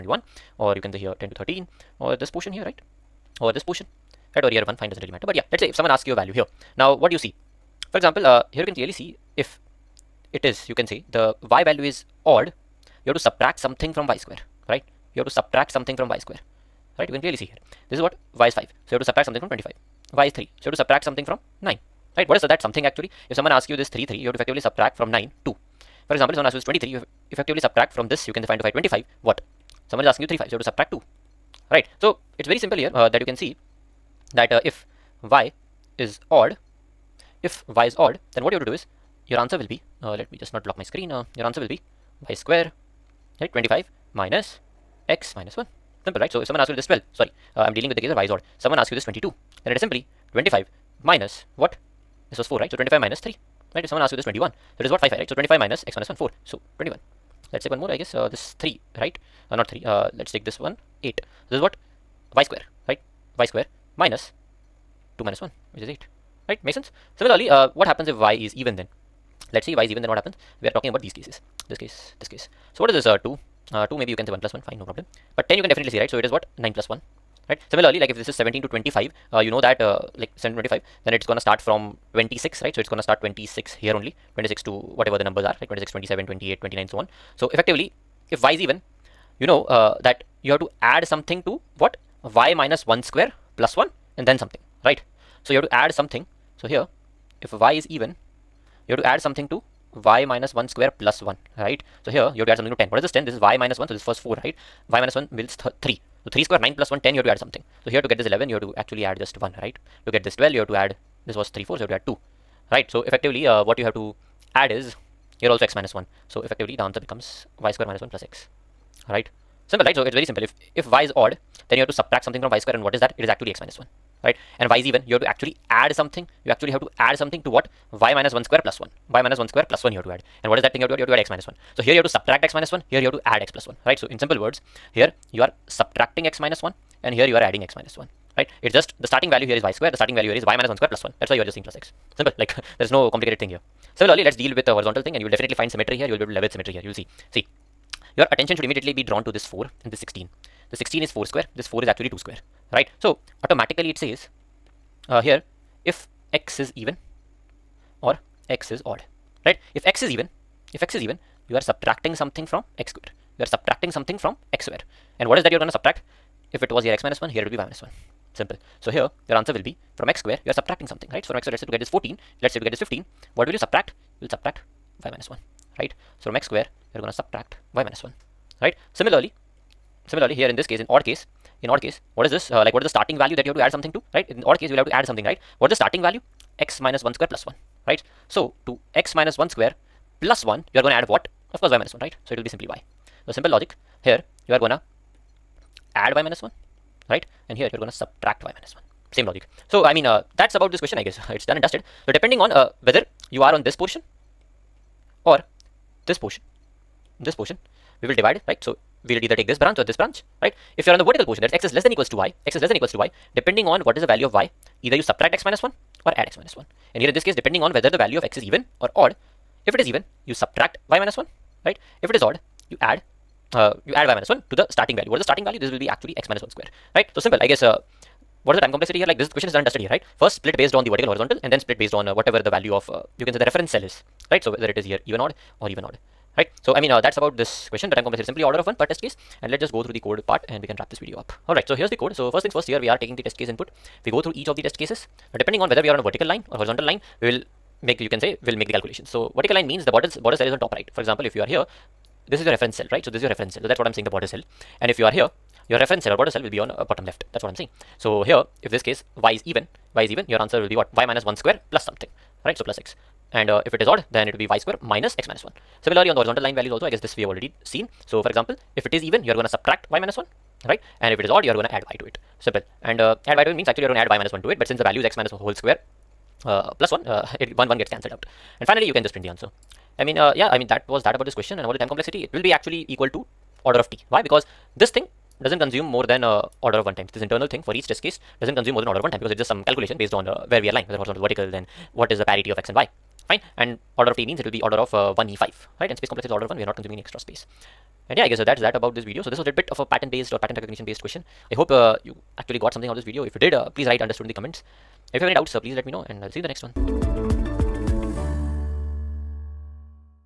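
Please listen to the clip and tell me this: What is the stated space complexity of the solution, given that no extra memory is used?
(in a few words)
Order of 1.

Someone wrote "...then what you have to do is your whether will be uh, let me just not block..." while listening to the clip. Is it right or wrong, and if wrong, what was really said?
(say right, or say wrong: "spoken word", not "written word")
wrong: "answer", not "whether".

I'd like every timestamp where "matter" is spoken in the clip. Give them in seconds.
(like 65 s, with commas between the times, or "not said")
5 s.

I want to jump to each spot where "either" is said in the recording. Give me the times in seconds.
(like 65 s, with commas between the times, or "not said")
209 s, 214 s.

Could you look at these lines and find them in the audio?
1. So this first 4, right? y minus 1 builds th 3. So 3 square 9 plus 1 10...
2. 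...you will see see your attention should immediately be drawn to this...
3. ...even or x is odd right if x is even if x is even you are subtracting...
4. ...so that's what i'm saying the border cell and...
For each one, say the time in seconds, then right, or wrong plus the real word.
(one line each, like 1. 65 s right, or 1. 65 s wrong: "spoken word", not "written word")
1. 103 s right
2. 146 s right
3. 156 s right
4. 253 s right.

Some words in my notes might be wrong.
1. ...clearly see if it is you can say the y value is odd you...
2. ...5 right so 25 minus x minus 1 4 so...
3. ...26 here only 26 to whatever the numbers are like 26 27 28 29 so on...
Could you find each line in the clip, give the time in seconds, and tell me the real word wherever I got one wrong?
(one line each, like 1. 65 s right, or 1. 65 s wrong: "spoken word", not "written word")
1. 8 s right
2. 55 s right
3. 83 s right.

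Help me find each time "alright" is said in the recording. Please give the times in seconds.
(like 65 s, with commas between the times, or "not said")
241 s.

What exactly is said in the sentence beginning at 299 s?
So this was a bit of a pattern based or pattern recognition based question.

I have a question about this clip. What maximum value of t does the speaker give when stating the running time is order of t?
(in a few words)
1e5.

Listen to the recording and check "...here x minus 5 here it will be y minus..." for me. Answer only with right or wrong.
wrong.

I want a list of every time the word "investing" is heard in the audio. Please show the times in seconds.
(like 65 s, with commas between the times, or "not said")
not said.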